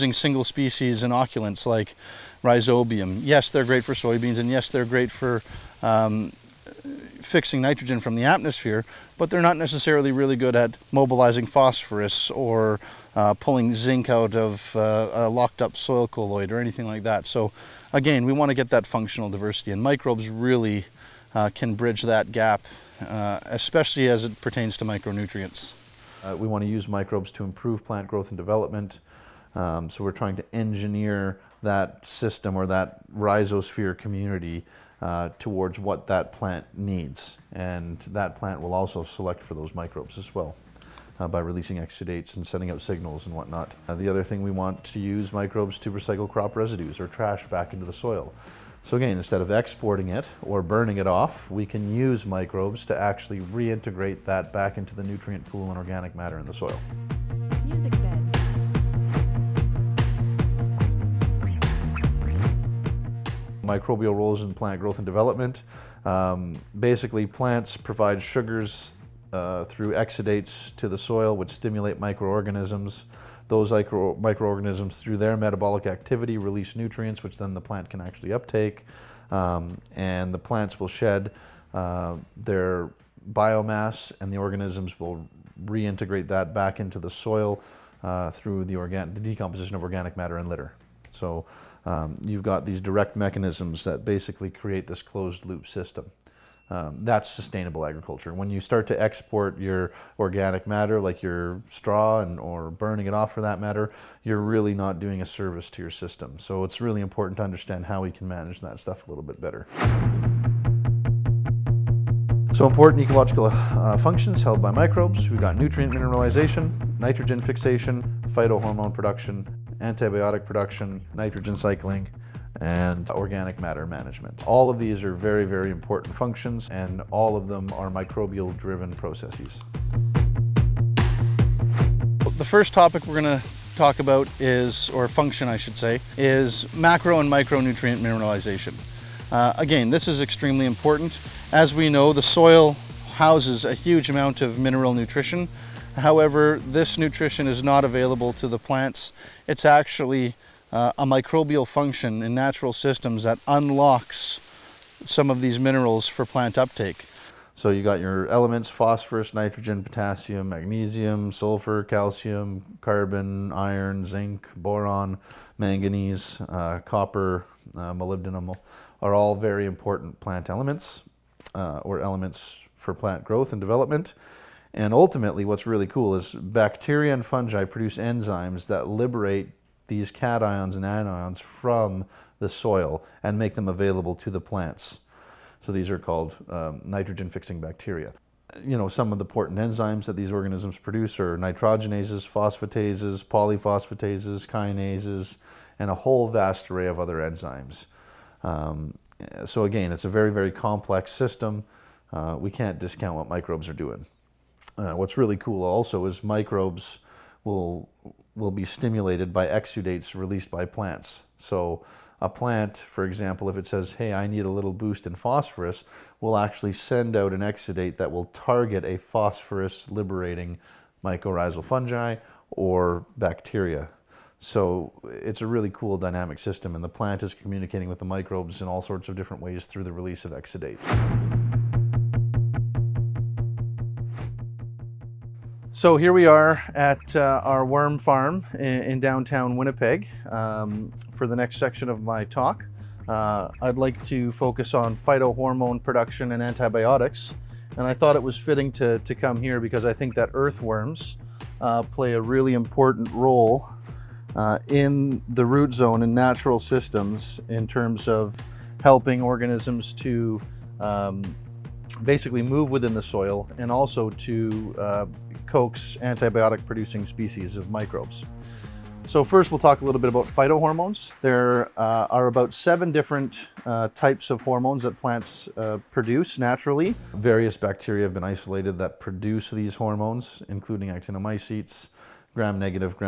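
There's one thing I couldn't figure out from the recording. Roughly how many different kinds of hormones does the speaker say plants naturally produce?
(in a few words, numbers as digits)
7.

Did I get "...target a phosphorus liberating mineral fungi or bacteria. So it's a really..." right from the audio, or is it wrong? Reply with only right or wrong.
wrong.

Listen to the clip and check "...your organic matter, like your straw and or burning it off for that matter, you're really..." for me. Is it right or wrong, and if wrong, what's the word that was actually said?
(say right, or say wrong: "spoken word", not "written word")
right.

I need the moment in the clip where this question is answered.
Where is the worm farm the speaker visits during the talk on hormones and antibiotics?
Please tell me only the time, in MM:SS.
03:59.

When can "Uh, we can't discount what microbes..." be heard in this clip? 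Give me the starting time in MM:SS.
03:22.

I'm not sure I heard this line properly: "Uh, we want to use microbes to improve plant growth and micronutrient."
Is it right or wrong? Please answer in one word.
wrong.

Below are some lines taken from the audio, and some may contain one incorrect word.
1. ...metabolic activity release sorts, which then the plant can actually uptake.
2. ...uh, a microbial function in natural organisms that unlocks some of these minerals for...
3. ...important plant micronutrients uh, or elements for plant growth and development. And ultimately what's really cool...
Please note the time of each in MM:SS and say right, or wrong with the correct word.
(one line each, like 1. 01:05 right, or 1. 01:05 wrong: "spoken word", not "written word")
1. 01:15 wrong: "nutrients", not "sorts"
2. 02:30 wrong: "systems", not "organisms"
3. 02:49 wrong: "elements", not "micronutrients".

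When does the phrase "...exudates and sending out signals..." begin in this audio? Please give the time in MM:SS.
00:41.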